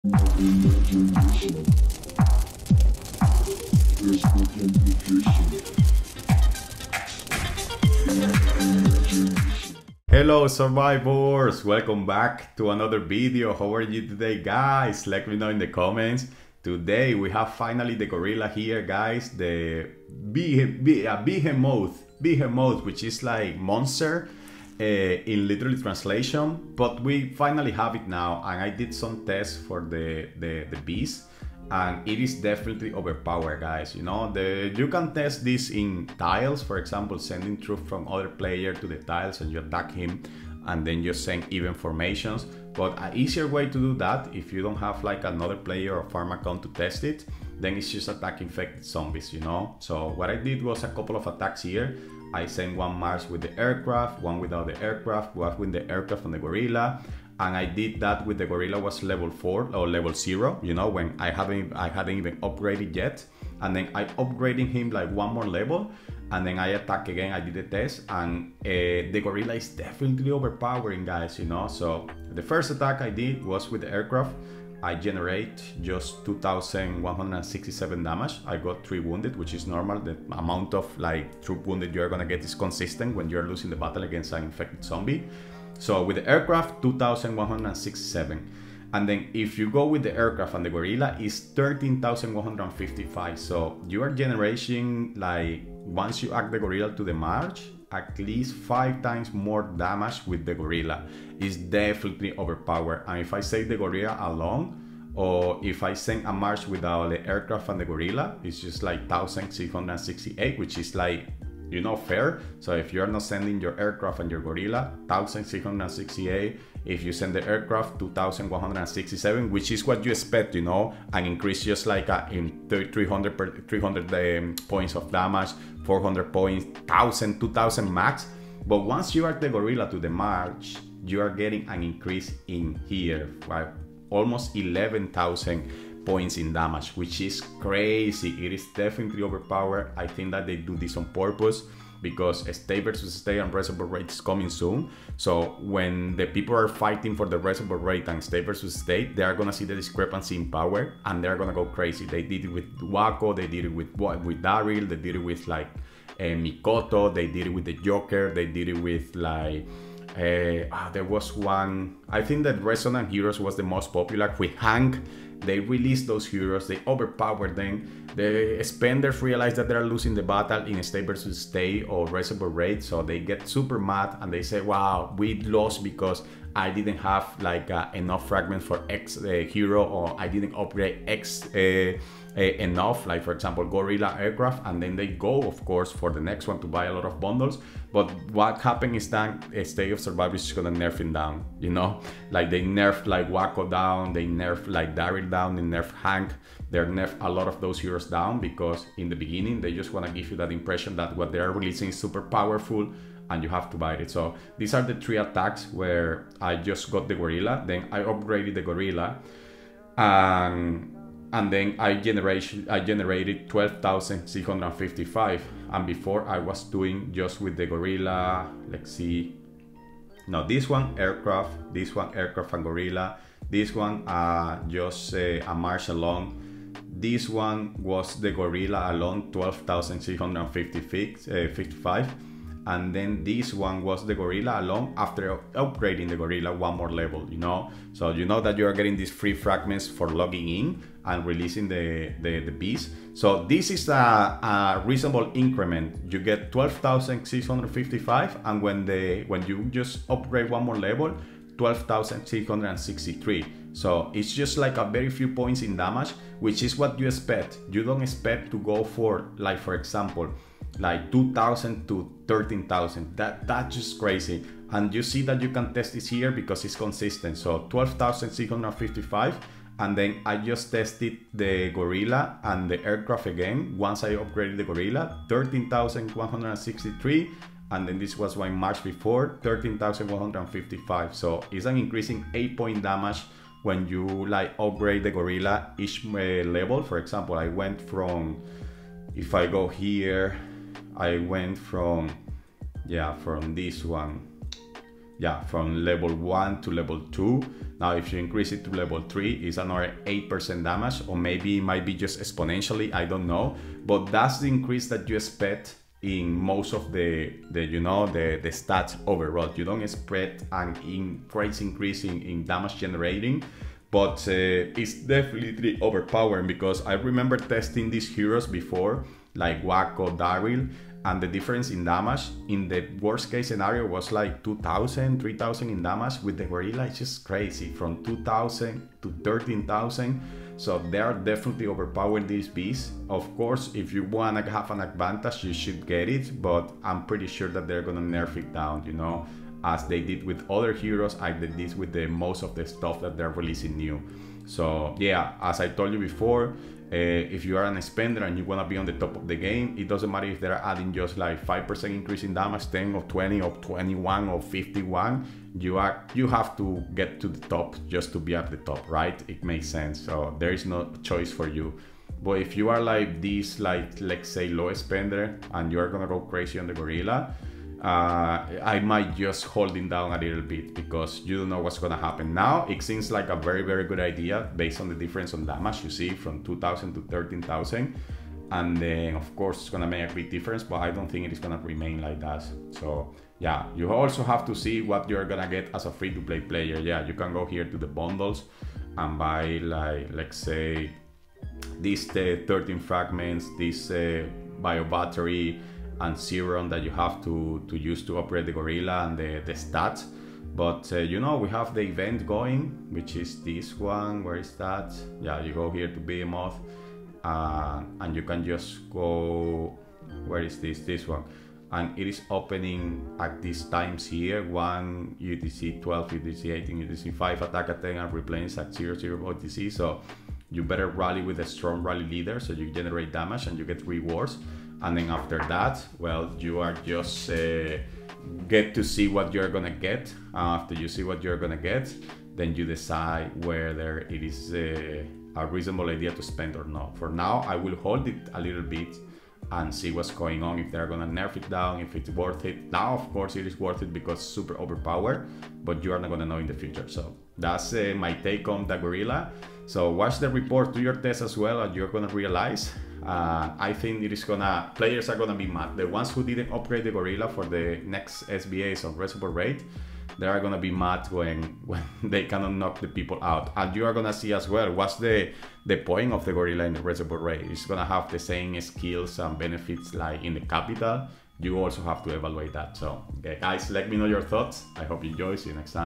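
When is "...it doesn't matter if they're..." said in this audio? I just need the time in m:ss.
5:49.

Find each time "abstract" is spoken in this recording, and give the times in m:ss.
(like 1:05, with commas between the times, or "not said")
not said.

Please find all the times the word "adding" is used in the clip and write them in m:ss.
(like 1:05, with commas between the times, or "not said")
5:50.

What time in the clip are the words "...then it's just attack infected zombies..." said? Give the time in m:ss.
0:47.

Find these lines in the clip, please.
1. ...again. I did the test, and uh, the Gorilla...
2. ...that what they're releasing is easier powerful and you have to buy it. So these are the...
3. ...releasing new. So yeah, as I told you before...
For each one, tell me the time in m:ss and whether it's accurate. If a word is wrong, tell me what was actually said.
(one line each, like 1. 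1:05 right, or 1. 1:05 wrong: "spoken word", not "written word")
1. 1:07 right
2. 3:20 wrong: "super", not "easier"
3. 5:43 right.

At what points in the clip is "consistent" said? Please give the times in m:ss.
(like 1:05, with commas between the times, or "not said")
1:22, 4:26.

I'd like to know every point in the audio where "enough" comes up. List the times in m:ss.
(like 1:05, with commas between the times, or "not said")
2:57, 3:02.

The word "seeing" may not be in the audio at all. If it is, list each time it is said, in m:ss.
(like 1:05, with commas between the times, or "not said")
not said.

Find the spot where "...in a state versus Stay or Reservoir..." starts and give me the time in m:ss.
2:50.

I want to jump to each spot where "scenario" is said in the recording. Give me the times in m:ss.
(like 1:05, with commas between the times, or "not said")
5:23.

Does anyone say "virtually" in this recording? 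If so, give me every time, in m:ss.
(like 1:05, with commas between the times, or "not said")
not said.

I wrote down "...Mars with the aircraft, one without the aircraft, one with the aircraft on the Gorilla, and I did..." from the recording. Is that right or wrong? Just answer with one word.
right.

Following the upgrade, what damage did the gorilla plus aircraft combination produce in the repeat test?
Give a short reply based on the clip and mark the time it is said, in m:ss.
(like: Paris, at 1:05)
13,163, at 4:35.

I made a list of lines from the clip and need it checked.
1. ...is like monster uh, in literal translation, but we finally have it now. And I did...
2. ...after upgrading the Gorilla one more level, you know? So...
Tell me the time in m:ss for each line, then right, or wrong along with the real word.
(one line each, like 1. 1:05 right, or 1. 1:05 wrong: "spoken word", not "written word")
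1. 0:23 right
2. 3:54 right.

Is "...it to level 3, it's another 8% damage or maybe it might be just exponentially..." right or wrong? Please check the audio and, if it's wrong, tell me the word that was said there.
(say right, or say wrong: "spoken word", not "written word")
right.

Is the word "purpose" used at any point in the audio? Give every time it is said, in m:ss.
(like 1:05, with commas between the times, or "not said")
2:21.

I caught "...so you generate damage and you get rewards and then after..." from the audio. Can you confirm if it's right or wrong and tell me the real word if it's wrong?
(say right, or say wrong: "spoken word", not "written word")
right.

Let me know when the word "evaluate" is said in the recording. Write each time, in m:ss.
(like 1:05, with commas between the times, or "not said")
7:52.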